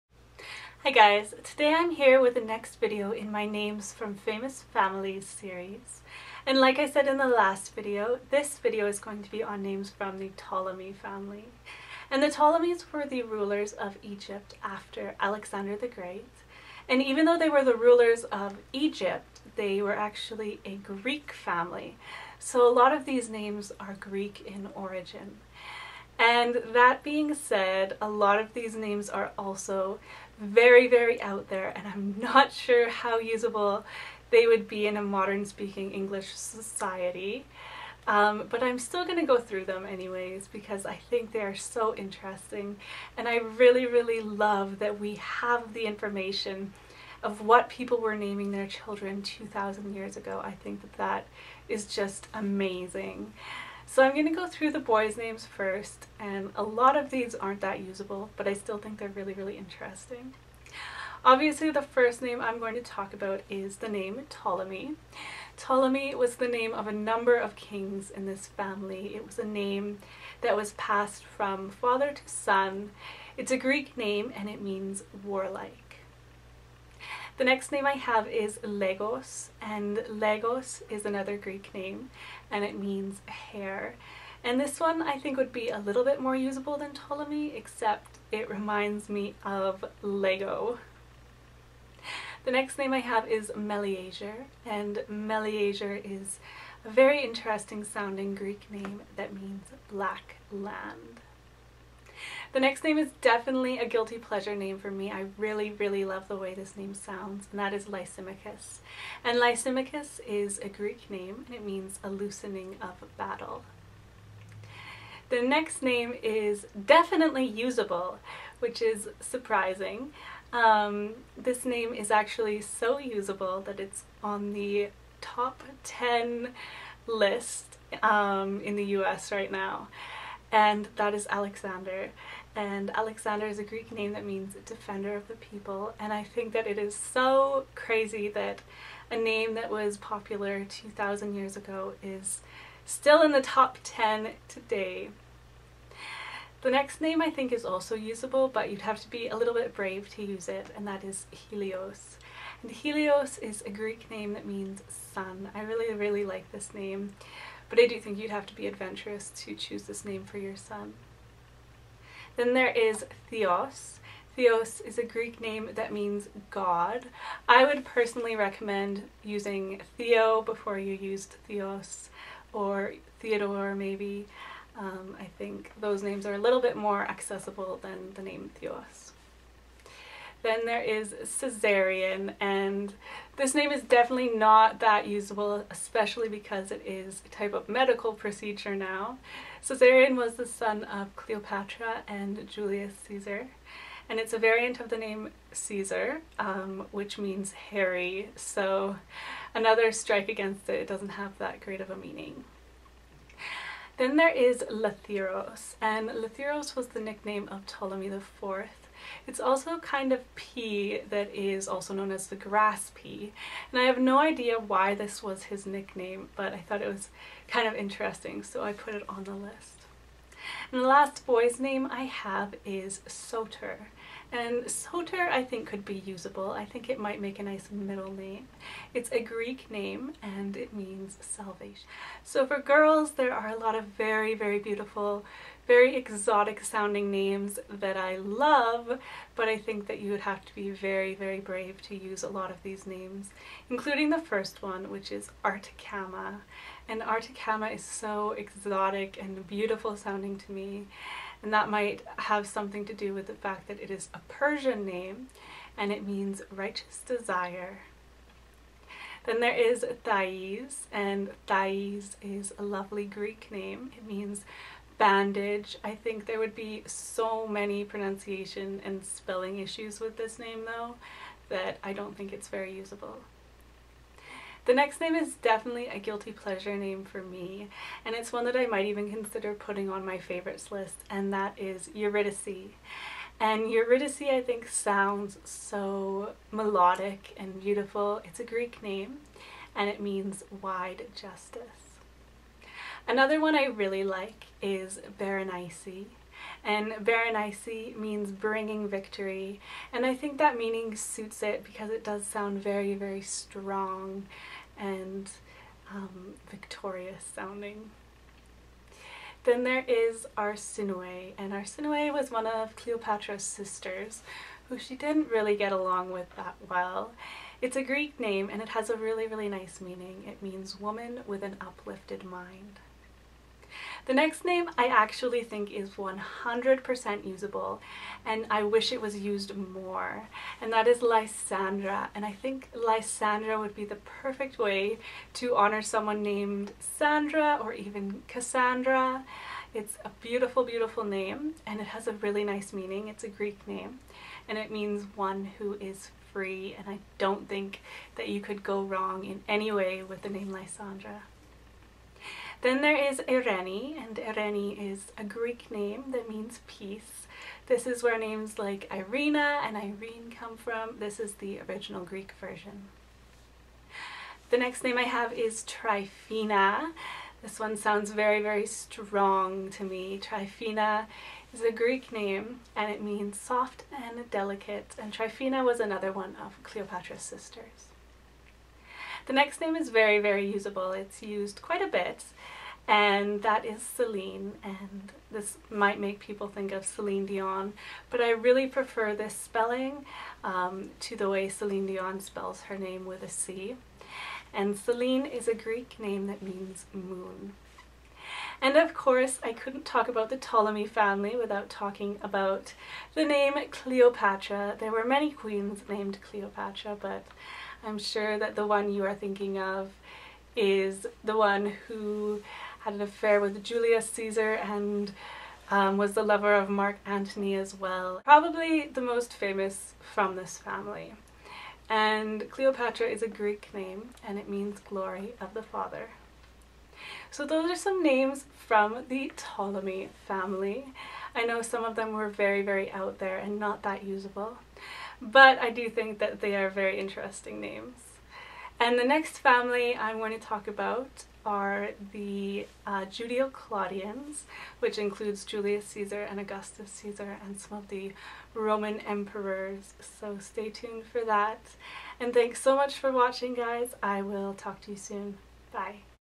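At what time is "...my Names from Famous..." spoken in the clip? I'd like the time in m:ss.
0:03.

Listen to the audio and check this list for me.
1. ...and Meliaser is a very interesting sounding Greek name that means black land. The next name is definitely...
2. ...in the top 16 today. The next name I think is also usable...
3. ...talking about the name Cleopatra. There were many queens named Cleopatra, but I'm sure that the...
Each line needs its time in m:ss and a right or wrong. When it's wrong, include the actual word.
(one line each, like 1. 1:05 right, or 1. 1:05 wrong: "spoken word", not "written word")
1. 1:34 right
2. 2:23 wrong: "10", not "16"
3. 6:41 right.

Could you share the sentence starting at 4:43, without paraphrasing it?
And Eurydice, I think, sounds so melodic and beautiful.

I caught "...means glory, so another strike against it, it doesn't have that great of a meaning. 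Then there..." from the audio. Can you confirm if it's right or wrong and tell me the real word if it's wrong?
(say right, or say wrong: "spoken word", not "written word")
wrong: "hairy", not "glory".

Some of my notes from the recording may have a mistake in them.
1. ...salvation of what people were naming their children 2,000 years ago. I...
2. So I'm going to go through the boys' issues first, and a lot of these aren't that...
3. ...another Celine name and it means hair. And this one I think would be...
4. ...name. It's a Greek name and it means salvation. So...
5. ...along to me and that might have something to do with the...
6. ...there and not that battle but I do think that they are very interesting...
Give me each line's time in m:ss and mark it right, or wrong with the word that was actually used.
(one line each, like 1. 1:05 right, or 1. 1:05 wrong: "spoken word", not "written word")
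1. 0:45 wrong: "information", not "salvation"
2. 0:53 wrong: "names", not "issues"
3. 1:21 wrong: "Greek", not "Celine"
4. 3:48 right
5. 4:09 wrong: "sounding", not "along"
6. 7:13 wrong: "usable", not "battle".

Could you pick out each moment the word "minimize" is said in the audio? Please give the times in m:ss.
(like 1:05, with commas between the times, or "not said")
not said.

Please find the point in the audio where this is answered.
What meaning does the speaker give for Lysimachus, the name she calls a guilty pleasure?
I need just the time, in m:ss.
1:52.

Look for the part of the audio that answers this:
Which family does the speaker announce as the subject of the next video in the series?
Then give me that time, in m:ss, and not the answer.
7:23.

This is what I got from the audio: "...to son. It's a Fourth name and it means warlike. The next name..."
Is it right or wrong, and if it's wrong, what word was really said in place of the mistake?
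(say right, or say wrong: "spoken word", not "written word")
wrong: "Greek", not "Fourth".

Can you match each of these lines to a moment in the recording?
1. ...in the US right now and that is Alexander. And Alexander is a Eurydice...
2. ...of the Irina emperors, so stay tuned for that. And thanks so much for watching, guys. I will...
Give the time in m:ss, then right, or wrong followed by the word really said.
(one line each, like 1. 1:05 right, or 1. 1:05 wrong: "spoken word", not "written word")
1. 2:08 wrong: "Greek", not "Eurydice"
2. 7:27 wrong: "Roman", not "Irina".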